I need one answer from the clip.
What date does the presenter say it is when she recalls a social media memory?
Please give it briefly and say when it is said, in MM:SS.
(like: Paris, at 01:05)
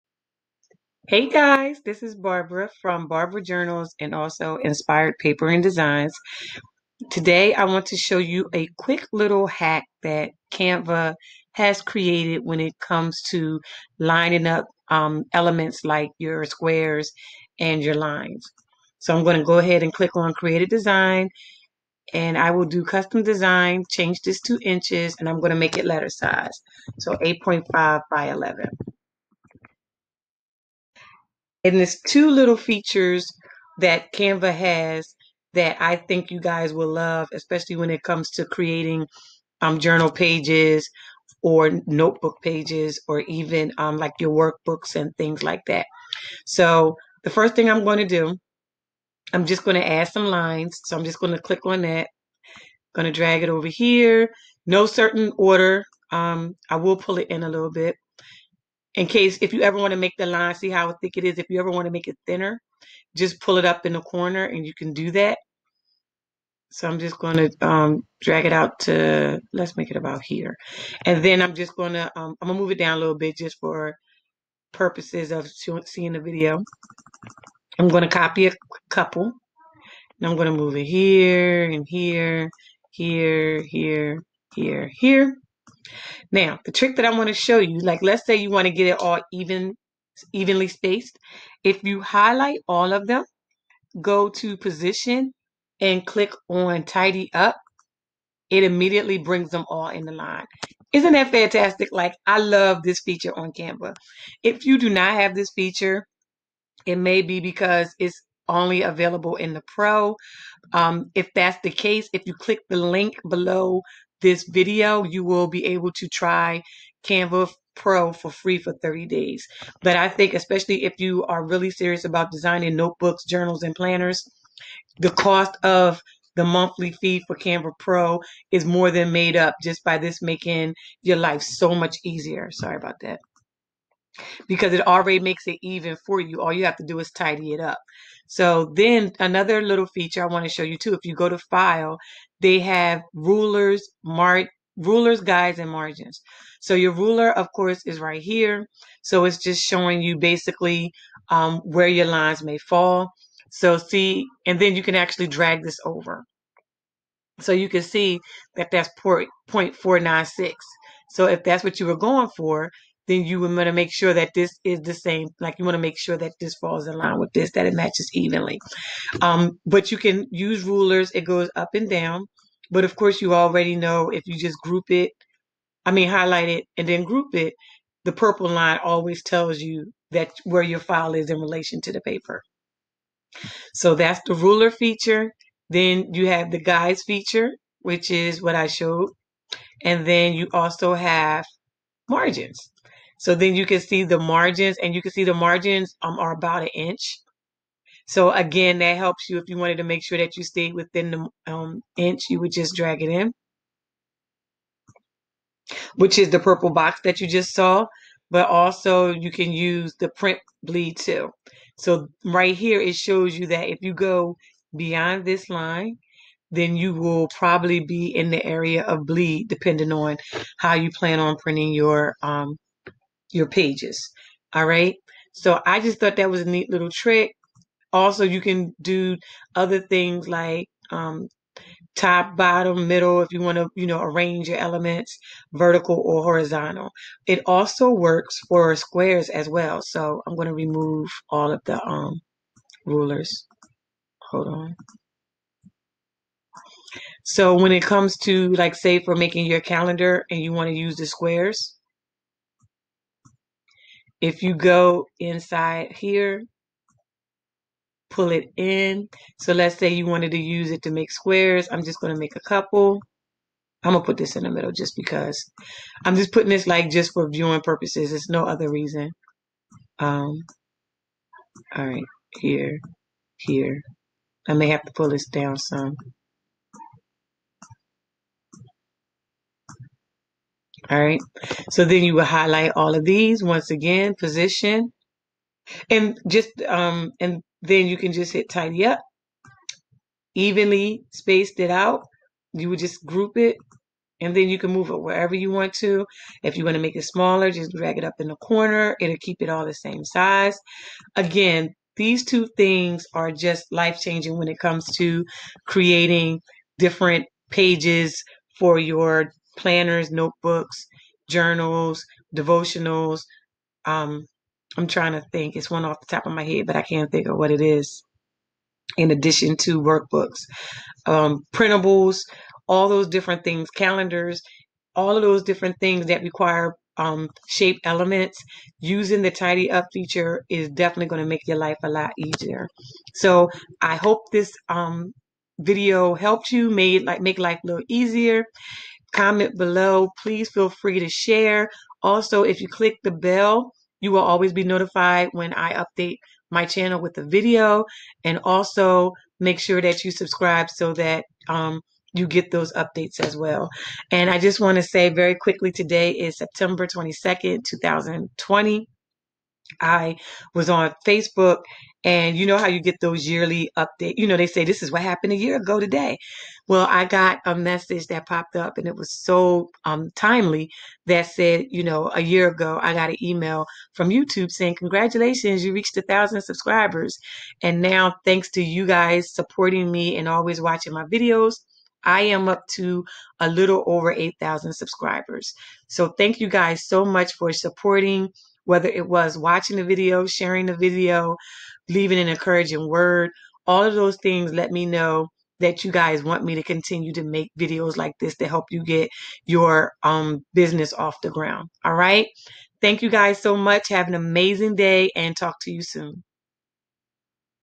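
September 22nd, 2020, at 05:56.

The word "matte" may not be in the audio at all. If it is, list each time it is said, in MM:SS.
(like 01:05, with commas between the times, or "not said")
not said.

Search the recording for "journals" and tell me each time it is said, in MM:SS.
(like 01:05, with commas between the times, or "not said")
00:03, 00:39, 02:03, 05:11.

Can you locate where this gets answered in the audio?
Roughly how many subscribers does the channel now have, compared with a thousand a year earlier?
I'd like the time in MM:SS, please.
06:24.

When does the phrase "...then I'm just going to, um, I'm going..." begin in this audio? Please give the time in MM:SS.
01:11.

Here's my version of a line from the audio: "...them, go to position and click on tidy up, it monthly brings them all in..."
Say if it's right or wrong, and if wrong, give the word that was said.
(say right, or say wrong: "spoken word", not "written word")
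wrong: "immediately", not "monthly".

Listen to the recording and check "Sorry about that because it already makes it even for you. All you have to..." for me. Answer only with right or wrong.
right.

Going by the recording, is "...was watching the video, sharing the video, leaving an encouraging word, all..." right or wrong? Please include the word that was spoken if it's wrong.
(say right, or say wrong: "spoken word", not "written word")
right.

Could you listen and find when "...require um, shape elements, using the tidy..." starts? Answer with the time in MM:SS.
05:26.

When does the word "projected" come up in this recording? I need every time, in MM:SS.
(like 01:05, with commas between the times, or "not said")
not said.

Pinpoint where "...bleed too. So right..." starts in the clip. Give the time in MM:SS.
03:30.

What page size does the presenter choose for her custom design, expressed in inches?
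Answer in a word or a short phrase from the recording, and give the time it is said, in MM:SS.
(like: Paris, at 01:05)
8.5 by 11, at 00:27.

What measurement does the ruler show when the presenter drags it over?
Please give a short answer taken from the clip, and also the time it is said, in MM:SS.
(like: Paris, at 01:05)
0.496, at 02:39.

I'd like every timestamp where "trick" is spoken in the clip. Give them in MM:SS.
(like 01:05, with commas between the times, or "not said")
01:26, 03:46.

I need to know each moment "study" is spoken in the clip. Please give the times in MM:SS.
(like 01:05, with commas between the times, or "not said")
not said.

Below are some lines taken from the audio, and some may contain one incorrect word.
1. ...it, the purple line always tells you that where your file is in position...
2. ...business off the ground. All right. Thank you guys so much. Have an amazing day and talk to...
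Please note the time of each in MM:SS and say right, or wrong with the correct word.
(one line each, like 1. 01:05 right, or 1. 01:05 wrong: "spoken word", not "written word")
1. 02:57 wrong: "relation", not "position"
2. 06:40 right.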